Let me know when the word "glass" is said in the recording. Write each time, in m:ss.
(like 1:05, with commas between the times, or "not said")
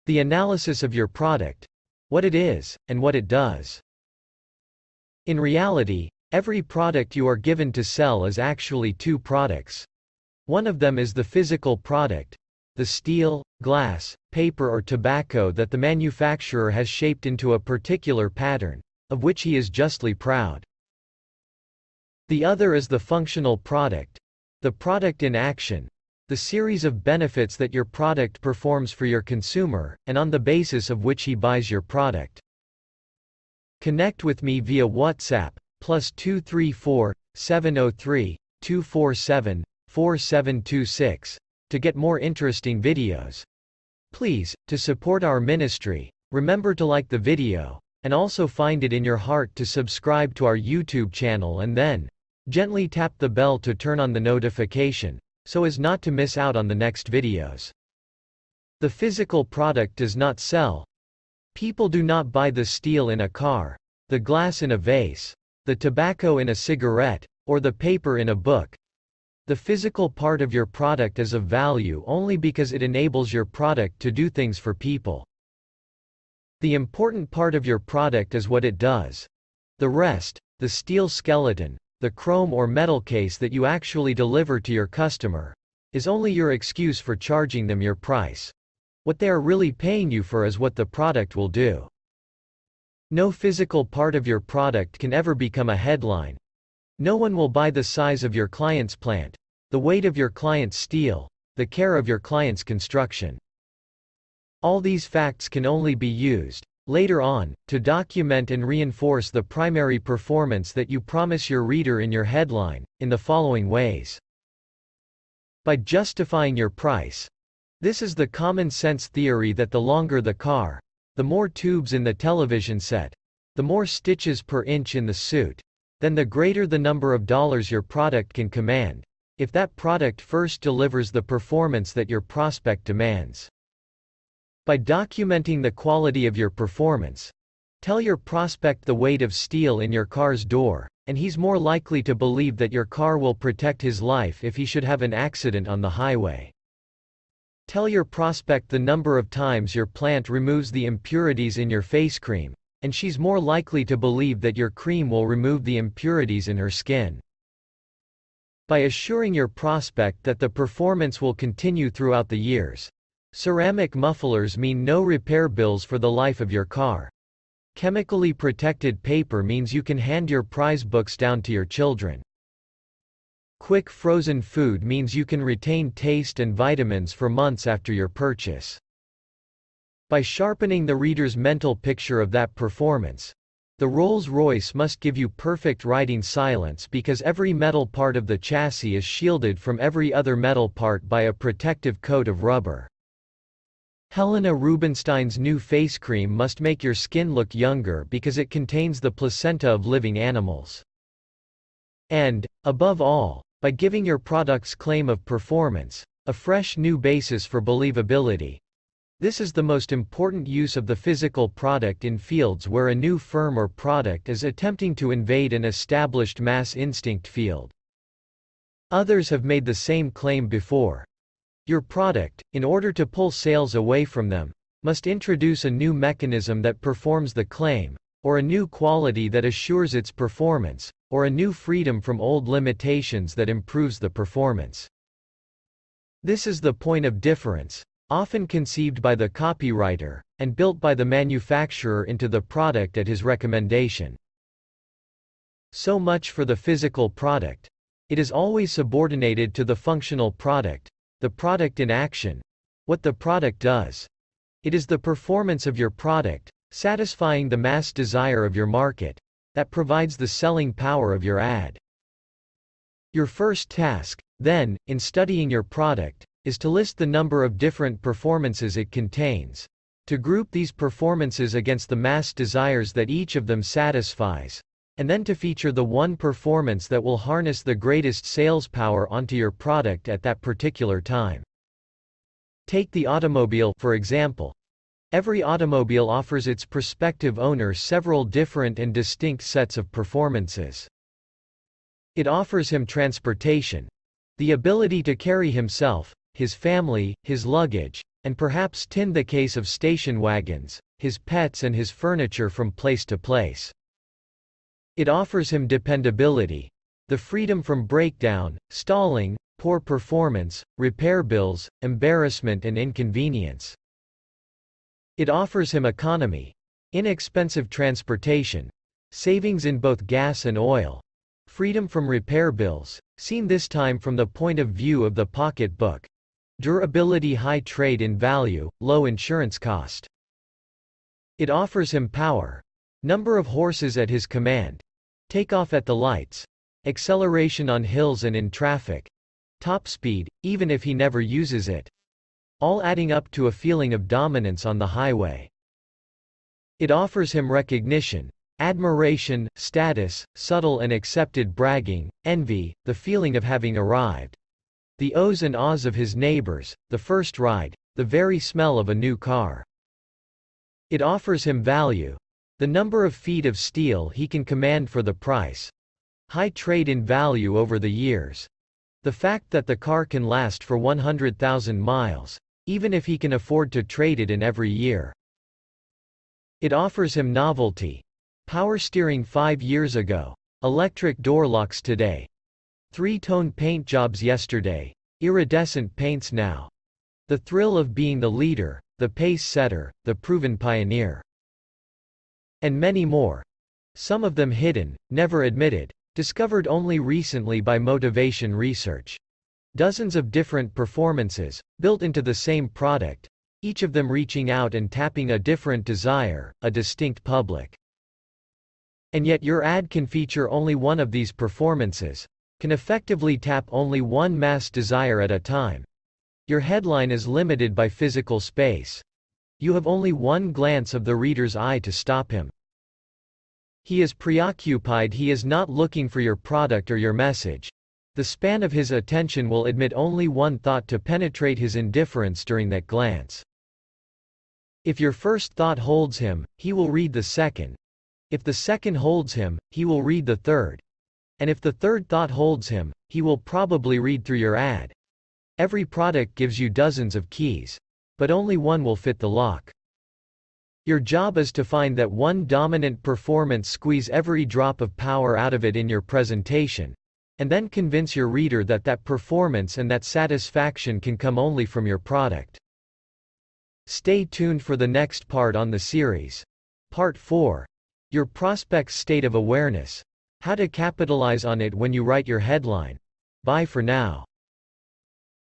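0:13, 1:04.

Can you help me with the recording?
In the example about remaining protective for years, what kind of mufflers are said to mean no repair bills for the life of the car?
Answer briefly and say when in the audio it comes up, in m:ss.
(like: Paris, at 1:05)
Ceramic, at 2:43.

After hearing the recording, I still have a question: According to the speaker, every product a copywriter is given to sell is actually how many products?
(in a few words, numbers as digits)
2.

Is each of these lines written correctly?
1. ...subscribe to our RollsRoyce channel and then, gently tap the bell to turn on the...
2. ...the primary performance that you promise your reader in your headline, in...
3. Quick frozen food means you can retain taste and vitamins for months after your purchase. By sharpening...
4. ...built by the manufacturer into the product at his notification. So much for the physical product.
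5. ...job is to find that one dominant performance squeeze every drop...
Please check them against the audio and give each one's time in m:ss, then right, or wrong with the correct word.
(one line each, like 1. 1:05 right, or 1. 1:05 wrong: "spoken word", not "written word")
1. 0:49 wrong: "YouTube", not "RollsRoyce"
2. 1:49 right
3. 2:53 right
4. 4:00 wrong: "recommendation", not "notification"
5. 7:30 right.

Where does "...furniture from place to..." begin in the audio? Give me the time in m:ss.
5:01.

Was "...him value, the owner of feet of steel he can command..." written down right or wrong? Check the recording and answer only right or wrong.
wrong.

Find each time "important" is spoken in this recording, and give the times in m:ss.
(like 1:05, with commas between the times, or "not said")
1:16, 3:29.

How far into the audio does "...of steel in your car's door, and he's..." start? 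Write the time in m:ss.
2:19.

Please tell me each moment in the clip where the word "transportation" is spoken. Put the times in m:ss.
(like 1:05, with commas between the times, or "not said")
4:52, 5:17.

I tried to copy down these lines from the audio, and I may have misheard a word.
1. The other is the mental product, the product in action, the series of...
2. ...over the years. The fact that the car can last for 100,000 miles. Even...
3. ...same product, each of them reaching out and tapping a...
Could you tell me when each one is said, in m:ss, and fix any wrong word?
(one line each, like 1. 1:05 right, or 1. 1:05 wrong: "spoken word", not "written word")
1. 0:22 wrong: "functional", not "mental"
2. 6:07 right
3. 6:42 right.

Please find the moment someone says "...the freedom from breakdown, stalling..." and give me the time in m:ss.
5:07.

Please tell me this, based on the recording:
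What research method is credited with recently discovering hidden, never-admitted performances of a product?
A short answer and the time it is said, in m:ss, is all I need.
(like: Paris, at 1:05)
motivation research, at 6:37.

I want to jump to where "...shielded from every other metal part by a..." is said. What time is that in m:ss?
3:09.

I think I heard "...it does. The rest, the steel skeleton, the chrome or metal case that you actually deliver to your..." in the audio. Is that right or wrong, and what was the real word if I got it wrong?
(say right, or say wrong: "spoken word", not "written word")
right.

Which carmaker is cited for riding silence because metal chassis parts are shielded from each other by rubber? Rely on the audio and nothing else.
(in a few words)
Rolls-Royce.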